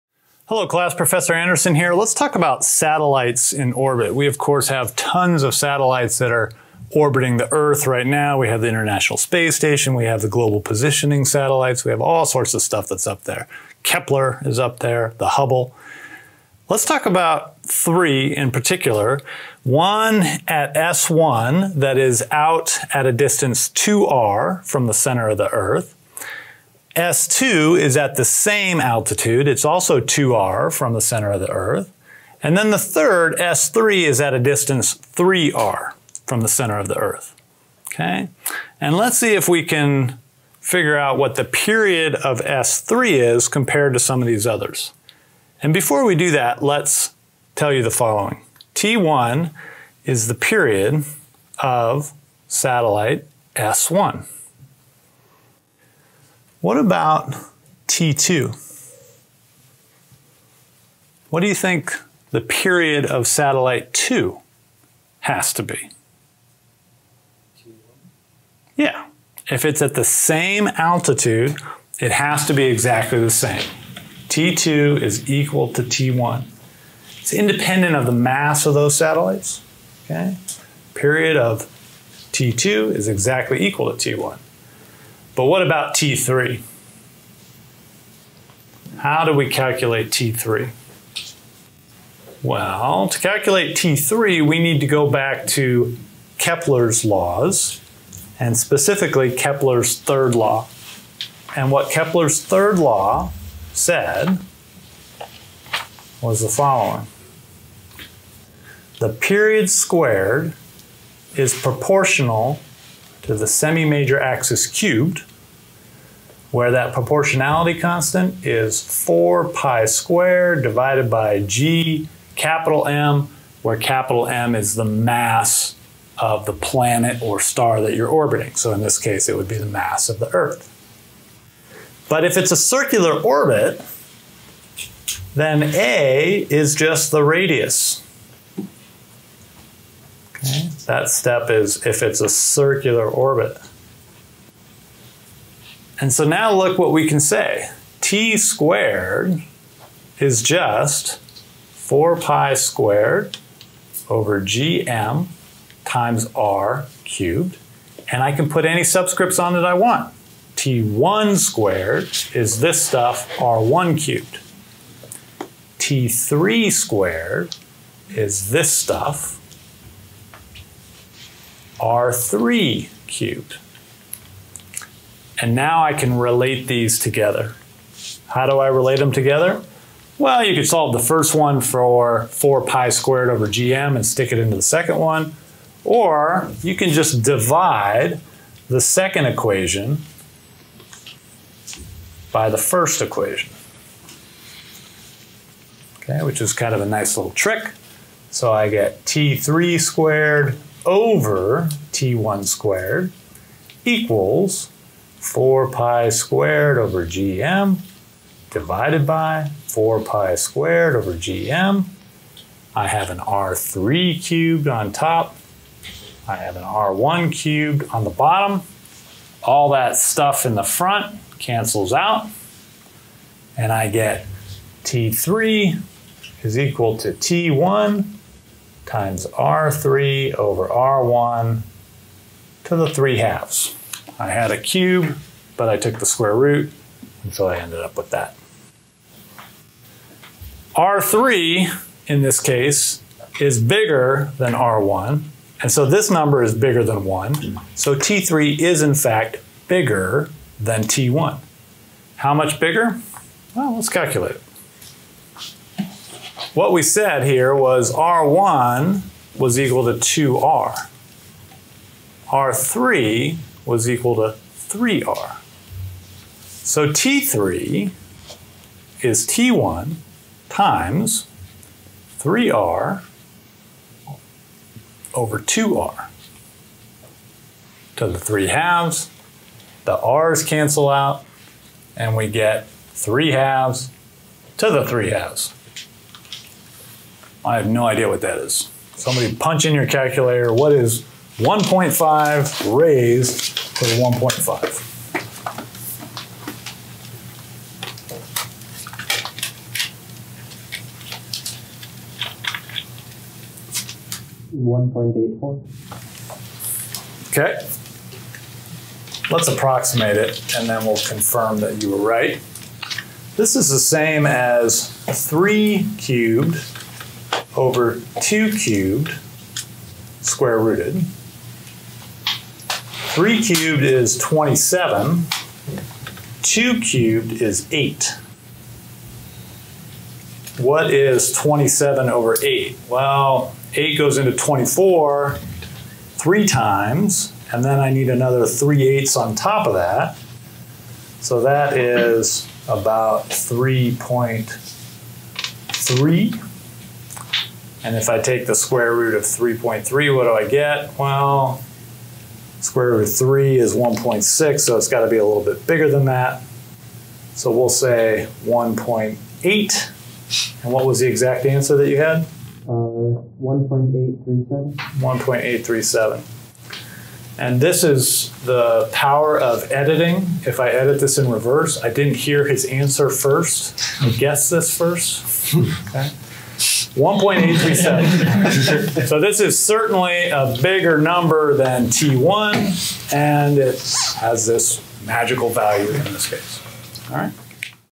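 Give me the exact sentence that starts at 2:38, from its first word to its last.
And I can put any subscripts on it I want.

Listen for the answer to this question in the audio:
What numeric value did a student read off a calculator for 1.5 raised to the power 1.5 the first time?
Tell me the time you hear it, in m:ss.
5:04.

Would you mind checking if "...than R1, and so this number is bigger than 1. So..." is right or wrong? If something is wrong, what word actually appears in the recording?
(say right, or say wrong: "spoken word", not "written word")
right.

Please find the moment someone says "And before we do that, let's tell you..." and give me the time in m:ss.
0:45.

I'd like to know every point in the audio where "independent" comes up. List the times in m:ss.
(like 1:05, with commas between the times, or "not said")
1:17.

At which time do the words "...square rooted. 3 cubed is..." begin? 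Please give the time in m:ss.
5:20.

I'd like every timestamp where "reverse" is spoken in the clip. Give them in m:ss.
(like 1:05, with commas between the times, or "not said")
6:11.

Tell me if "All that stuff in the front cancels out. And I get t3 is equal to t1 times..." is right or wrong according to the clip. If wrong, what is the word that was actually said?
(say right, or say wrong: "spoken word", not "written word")
right.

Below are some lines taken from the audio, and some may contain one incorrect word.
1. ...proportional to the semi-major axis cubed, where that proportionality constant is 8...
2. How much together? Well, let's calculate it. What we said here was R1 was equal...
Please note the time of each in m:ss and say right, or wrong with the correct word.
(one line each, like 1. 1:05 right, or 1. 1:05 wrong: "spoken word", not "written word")
1. 1:51 wrong: "4", not "8"
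2. 4:12 wrong: "bigger", not "together".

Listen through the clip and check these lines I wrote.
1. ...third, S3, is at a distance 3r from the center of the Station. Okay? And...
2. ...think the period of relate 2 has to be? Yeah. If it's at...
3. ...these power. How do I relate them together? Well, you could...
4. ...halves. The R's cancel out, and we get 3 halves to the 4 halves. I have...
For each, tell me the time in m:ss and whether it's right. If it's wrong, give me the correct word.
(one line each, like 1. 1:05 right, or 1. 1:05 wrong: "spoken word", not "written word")
1. 0:32 wrong: "Earth", not "Station"
2. 1:01 wrong: "satellite", not "relate"
3. 2:56 wrong: "together", not "power"
4. 4:38 wrong: "3", not "4".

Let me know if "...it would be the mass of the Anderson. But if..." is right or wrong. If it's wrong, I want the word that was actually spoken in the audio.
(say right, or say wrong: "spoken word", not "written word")
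wrong: "Earth", not "Anderson".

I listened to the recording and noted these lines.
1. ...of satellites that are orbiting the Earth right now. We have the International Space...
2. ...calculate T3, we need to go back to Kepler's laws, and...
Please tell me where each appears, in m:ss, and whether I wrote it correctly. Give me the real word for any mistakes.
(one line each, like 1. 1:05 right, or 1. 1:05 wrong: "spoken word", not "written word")
1. 0:05 right
2. 1:33 right.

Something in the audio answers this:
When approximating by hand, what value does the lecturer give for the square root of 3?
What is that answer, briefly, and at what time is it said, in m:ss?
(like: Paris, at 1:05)
1.6, at 5:53.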